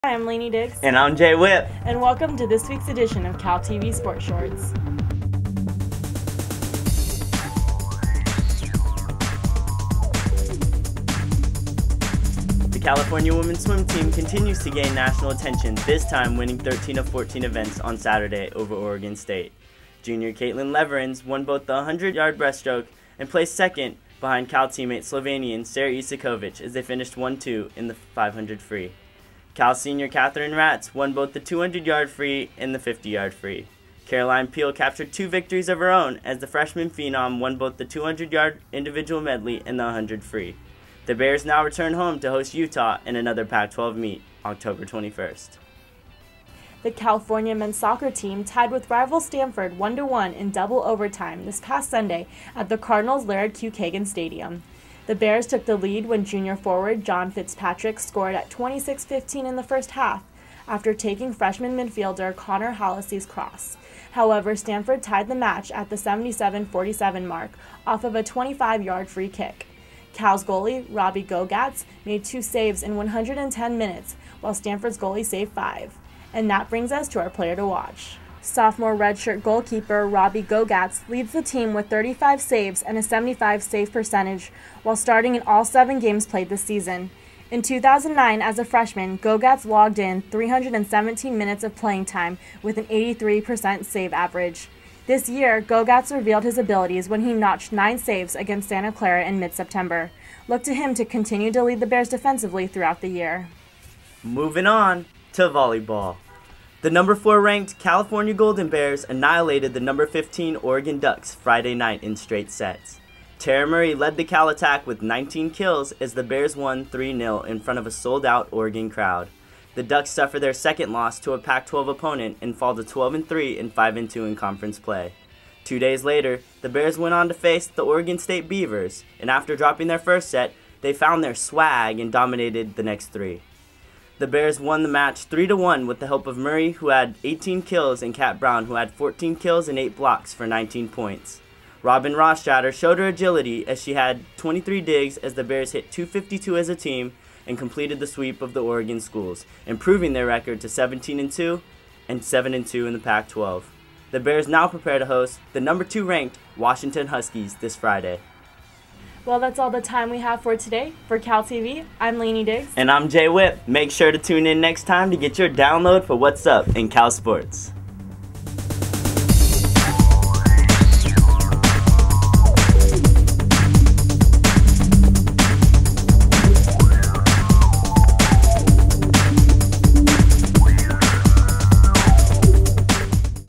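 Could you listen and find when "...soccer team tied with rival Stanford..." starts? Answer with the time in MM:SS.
00:47.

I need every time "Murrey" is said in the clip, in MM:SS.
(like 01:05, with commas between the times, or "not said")
01:53, 02:16.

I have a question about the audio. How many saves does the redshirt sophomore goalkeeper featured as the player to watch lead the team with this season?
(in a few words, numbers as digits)
35.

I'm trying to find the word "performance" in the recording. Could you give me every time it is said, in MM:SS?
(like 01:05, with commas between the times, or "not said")
not said.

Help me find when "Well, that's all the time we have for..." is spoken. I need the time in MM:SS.
02:39.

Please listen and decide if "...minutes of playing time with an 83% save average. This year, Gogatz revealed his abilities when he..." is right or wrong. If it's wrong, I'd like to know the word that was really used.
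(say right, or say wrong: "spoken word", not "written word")
right.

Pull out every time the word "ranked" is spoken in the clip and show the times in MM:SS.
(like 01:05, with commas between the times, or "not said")
01:47, 02:36.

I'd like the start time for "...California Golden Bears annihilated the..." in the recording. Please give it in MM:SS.
01:47.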